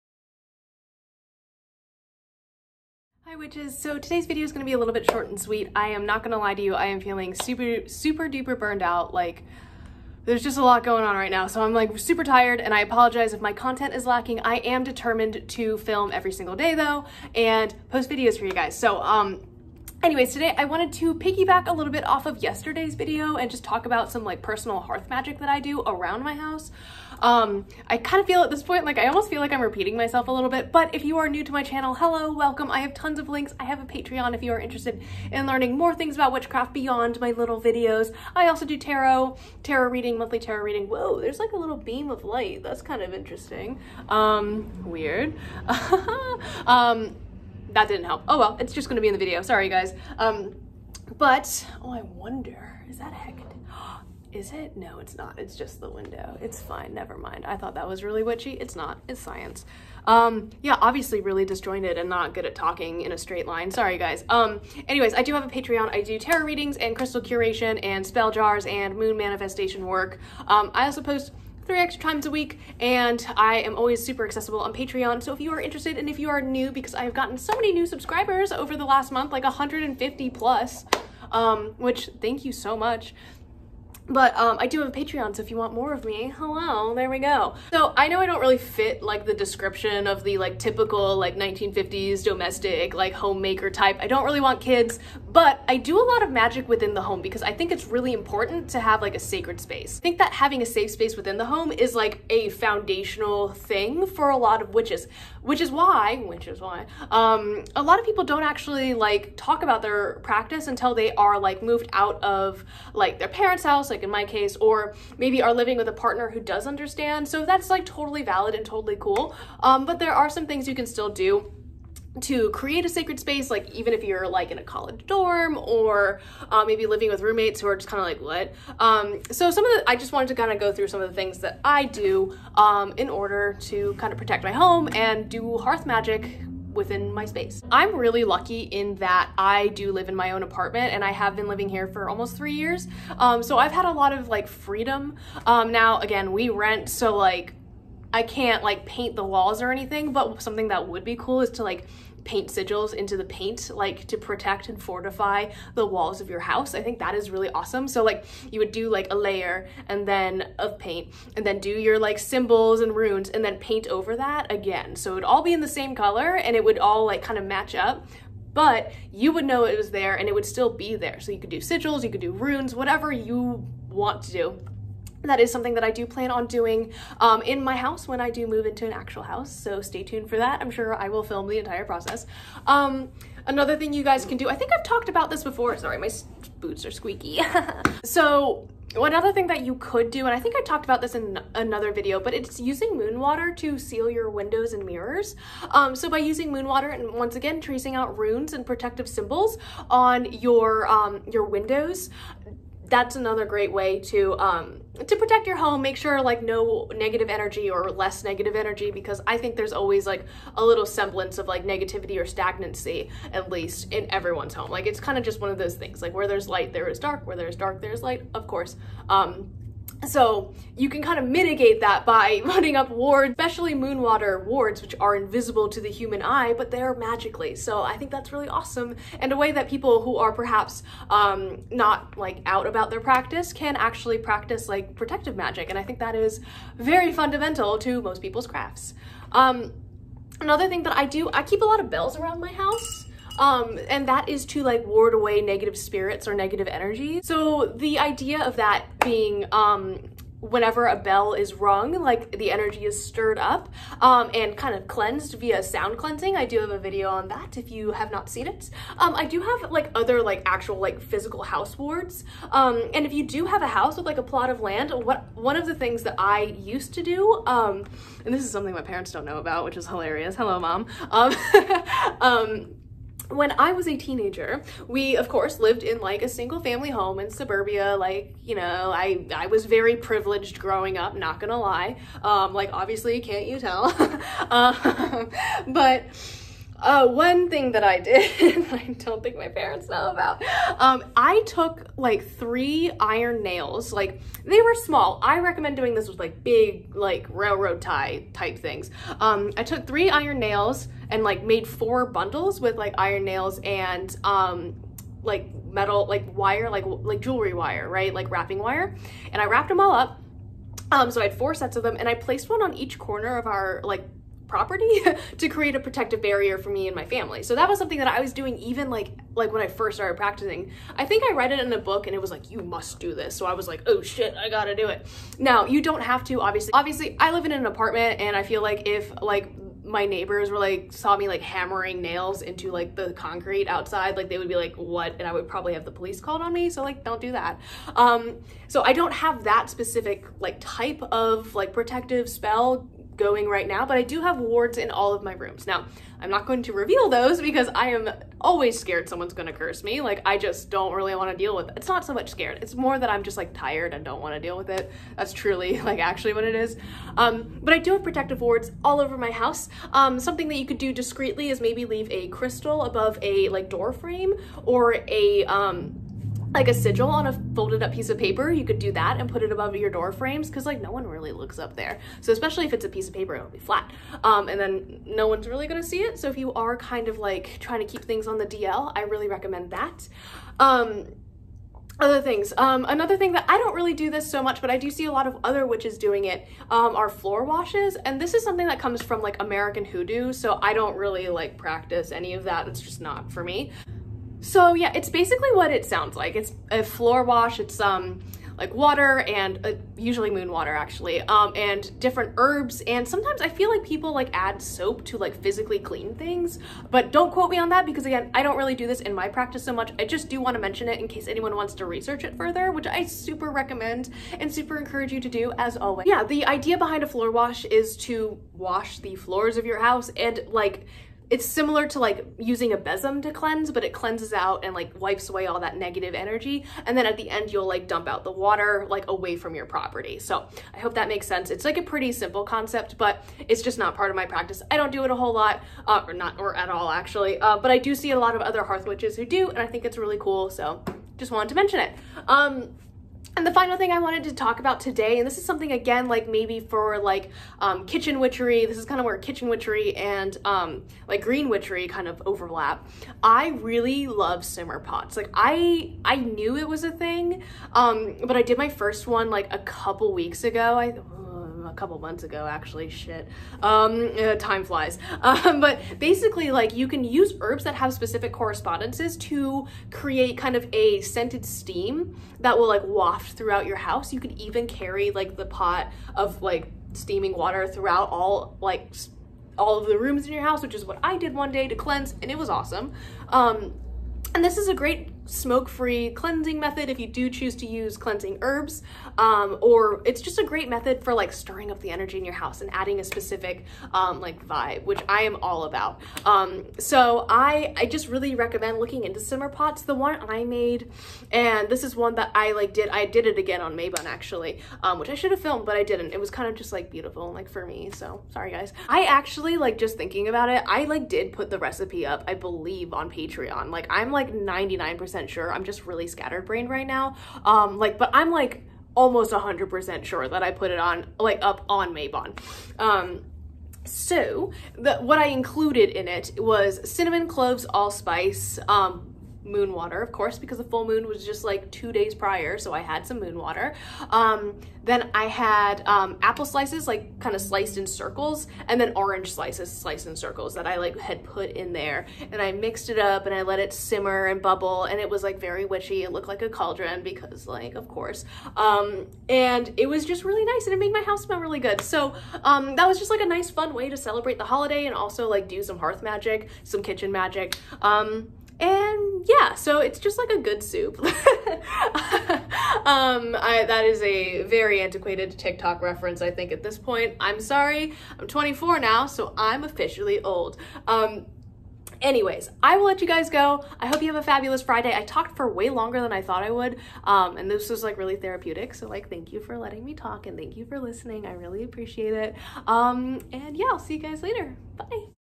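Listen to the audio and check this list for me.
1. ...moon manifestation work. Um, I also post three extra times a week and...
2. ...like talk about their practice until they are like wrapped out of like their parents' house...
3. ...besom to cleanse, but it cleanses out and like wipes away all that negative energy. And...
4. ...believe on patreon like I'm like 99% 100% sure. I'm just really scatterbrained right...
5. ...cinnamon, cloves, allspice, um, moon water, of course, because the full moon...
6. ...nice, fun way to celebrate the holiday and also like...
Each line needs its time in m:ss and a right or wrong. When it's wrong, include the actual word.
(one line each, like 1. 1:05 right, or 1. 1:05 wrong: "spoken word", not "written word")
1. 1:08 right
2. 1:48 wrong: "moved", not "wrapped"
3. 7:02 right
4. 8:32 right
5. 8:46 right
6. 9:13 right.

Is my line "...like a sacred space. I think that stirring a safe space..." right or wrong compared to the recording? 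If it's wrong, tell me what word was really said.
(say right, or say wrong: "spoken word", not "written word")
wrong: "having", not "stirring".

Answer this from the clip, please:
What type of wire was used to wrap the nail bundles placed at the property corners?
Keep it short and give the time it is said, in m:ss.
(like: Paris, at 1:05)
jewelry wire, at 5:07.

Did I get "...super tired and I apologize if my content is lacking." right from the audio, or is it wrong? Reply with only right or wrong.
right.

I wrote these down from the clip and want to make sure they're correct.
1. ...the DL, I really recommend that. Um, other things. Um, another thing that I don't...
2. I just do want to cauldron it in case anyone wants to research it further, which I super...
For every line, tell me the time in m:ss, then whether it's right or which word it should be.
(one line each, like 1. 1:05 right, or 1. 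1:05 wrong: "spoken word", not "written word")
1. 6:18 right
2. 6:49 wrong: "mention", not "cauldron".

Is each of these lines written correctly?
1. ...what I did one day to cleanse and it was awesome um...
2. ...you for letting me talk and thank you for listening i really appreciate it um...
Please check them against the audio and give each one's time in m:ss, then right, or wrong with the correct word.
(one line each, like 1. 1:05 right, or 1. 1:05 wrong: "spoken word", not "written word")
1. 8:00 right
2. 9:39 right.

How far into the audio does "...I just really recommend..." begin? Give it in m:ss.
8:17.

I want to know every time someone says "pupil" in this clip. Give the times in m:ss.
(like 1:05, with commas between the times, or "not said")
not said.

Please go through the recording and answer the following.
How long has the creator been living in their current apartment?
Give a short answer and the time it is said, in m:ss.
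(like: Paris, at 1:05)
almost three years, at 2:22.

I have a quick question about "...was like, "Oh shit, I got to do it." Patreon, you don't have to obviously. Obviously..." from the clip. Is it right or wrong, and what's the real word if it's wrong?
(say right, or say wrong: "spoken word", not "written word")
wrong: "Now", not "Patreon".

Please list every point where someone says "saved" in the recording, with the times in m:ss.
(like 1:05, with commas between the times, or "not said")
not said.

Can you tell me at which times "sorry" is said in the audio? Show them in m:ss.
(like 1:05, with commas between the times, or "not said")
0:49, 1:03, 3:05, 8:28, 9:27.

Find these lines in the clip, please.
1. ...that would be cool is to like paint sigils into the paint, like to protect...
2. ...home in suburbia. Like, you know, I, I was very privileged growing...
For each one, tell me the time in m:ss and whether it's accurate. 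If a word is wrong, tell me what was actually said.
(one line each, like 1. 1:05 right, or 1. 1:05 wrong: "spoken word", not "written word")
1. 2:30 right
2. 4:36 right.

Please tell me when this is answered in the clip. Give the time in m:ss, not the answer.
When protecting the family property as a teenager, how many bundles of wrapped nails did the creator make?
5:01.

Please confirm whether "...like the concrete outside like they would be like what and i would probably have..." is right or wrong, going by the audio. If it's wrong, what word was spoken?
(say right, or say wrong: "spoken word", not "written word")
right.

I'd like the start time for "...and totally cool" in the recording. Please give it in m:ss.
1:58.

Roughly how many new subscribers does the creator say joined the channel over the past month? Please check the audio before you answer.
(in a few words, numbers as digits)
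150 plus.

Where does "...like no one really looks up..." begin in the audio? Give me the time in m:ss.
6:10.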